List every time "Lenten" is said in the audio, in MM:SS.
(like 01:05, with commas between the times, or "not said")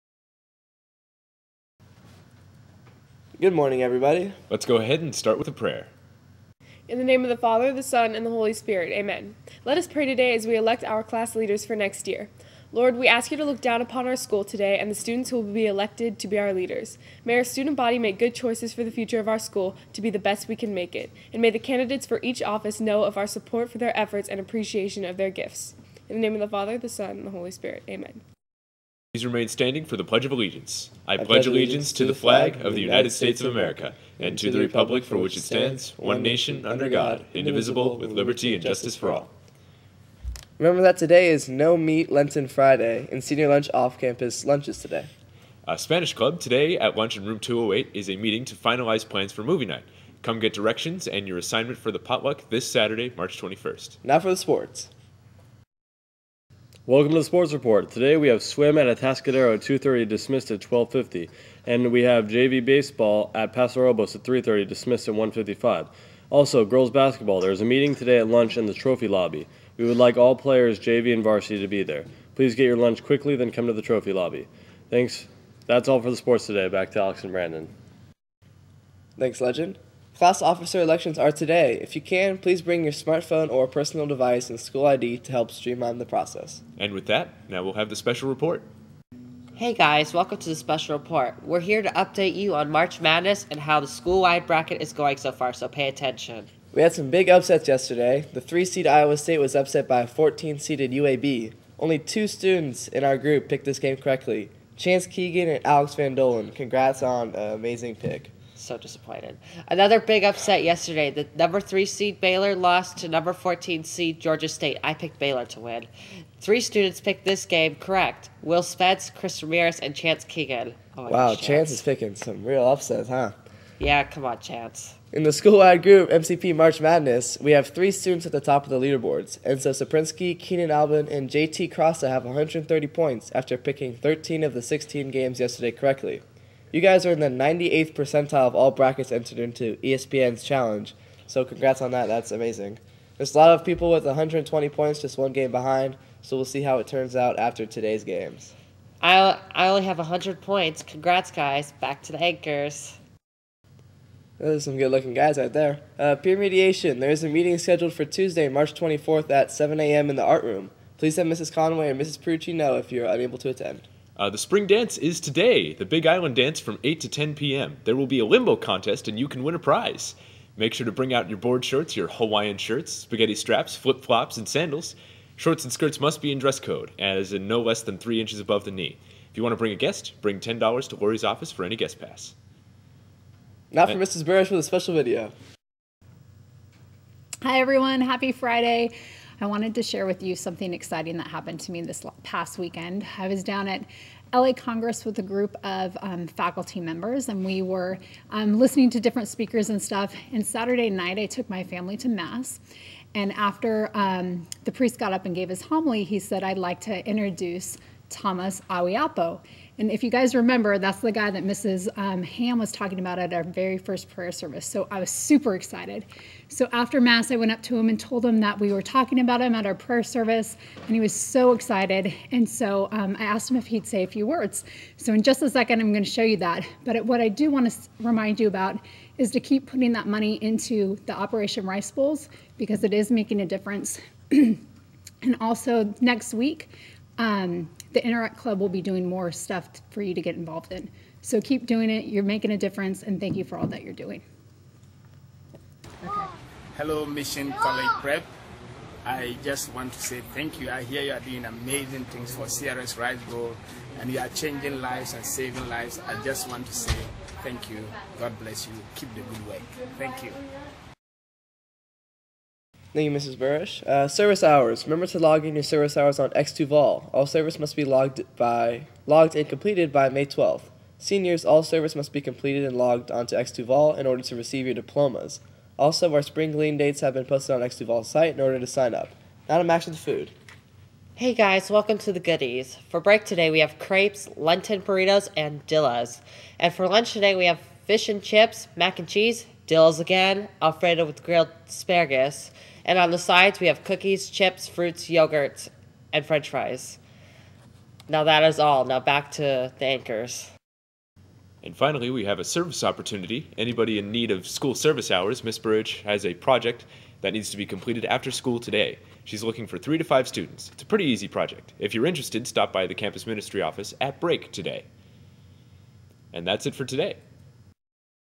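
00:42, 04:44.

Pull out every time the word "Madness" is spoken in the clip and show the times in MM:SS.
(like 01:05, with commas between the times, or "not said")
01:33, 02:06.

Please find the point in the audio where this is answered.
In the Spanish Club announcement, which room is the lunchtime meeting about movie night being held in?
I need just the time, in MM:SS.
00:47.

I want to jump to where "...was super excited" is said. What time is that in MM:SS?
03:34.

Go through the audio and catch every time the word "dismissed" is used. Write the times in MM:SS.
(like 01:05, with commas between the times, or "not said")
01:00, 01:04.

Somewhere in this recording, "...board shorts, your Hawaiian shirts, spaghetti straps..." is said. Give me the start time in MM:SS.
02:51.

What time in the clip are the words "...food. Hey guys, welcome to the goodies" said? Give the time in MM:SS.
04:39.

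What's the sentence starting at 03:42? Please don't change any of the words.
And so um, I asked him if he'd say a few words.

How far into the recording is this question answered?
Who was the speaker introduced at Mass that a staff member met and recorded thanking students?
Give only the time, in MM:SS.
03:28.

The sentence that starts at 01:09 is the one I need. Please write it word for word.
We would like all players, JV and varsity, to be there.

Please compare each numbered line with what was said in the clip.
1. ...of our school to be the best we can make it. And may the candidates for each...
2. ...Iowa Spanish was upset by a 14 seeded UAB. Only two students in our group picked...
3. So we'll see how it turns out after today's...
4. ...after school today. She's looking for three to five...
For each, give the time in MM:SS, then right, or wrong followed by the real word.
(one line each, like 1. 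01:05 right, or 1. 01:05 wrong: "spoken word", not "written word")
1. 00:19 right
2. 01:38 wrong: "State", not "Spanish"
3. 02:26 right
4. 05:08 right.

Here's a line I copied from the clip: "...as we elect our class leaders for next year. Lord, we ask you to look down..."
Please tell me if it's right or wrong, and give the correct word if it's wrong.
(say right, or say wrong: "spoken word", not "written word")
right.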